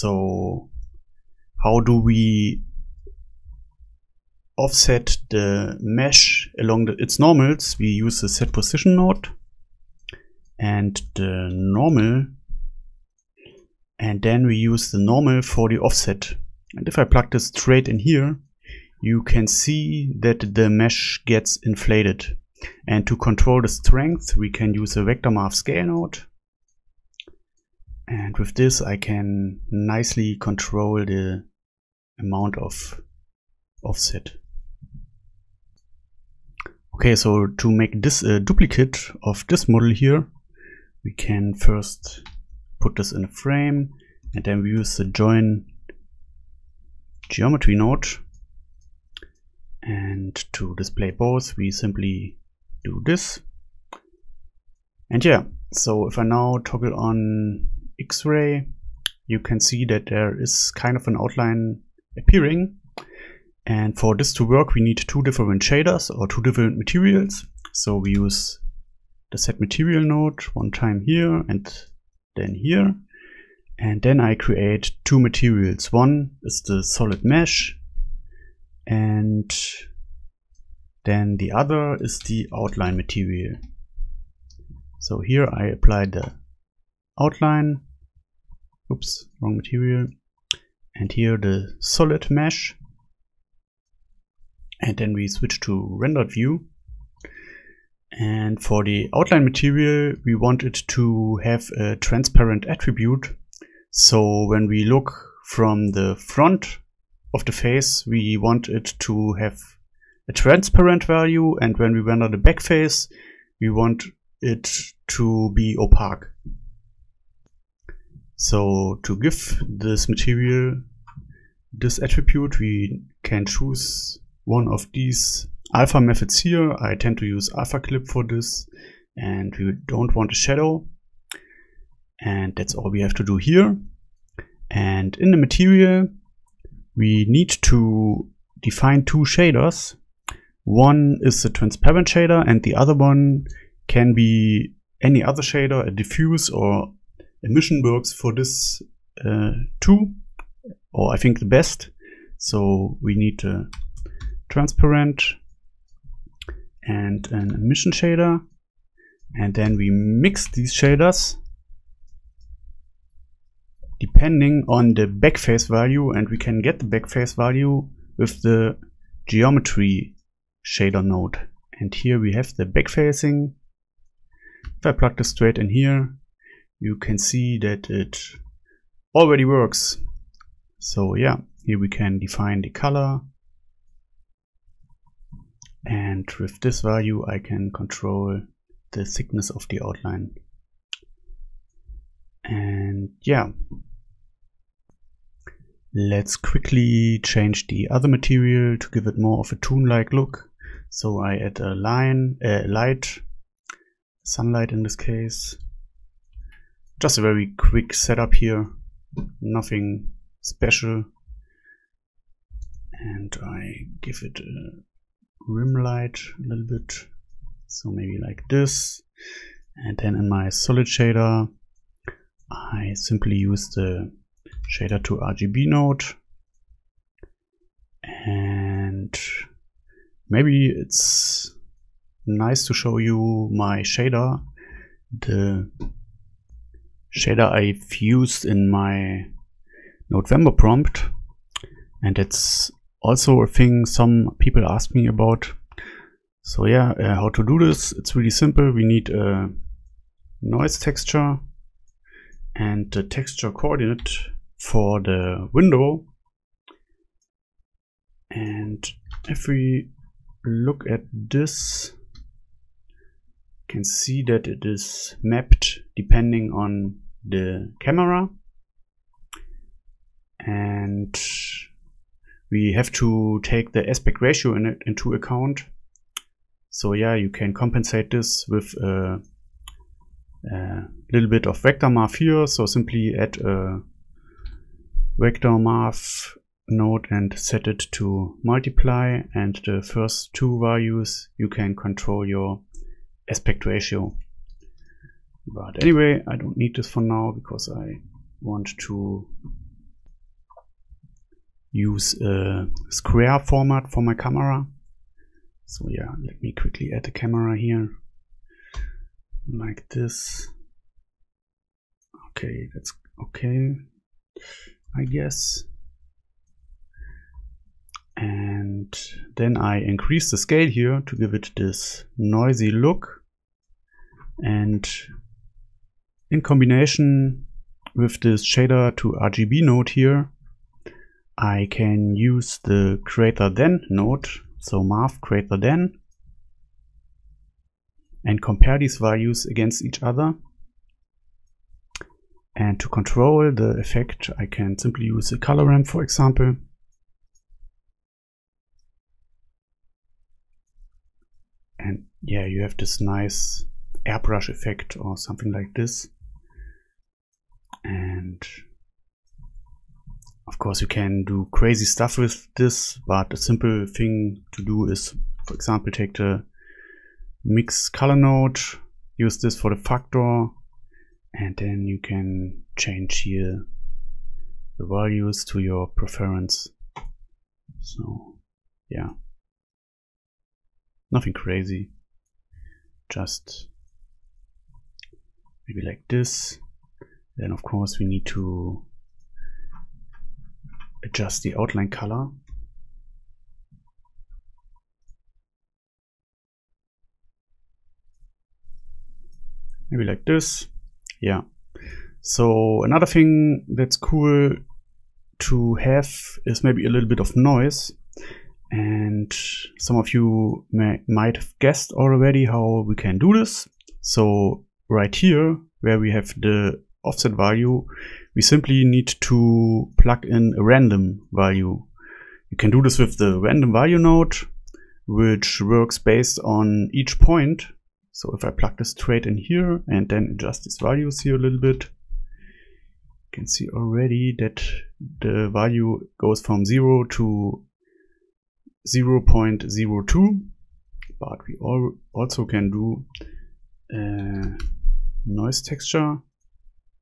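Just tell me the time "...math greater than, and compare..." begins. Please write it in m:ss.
5:34.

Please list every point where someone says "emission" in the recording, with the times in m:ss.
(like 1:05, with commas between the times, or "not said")
2:27, 2:37.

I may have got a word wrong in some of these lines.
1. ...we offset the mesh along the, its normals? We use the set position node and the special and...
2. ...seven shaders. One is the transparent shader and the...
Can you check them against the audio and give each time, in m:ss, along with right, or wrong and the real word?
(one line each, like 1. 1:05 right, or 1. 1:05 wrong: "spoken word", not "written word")
1. 0:01 wrong: "normal", not "special"
2. 2:19 wrong: "two", not "seven".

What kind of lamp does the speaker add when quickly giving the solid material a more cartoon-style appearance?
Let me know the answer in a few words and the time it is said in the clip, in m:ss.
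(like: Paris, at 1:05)
Sunlight, at 3:24.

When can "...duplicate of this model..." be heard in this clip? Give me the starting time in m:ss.
0:38.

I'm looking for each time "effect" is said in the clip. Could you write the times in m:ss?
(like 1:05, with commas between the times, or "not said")
5:43, 5:54.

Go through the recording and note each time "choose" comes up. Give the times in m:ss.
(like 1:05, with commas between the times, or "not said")
2:03.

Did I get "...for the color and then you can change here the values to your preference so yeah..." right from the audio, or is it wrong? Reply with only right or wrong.
wrong.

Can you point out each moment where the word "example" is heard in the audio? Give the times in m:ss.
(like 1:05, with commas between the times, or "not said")
5:46, 6:05.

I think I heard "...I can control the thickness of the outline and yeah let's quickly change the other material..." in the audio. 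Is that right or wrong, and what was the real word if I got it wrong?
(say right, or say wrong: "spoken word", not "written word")
right.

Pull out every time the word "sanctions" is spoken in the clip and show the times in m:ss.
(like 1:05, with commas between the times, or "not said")
not said.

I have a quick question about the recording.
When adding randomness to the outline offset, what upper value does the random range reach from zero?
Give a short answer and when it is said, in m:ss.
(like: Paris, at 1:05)
0.02, at 7:18.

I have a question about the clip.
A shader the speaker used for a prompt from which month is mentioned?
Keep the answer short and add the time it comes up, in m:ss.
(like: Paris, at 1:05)
November, at 4:00.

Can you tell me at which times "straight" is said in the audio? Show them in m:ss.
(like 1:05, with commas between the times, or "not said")
0:17, 2:55, 7:08.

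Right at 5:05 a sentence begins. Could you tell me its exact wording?
So yeah, let me quickly add a camera here like this.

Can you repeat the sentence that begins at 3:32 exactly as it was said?
And I give it a rim light a little bit, so maybe like this.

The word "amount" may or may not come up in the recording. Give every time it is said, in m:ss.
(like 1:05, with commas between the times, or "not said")
0:32.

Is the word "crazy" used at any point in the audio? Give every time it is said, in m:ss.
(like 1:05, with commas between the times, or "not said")
6:01, 6:21.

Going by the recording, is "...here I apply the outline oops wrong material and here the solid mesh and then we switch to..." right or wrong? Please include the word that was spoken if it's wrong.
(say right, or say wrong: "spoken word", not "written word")
right.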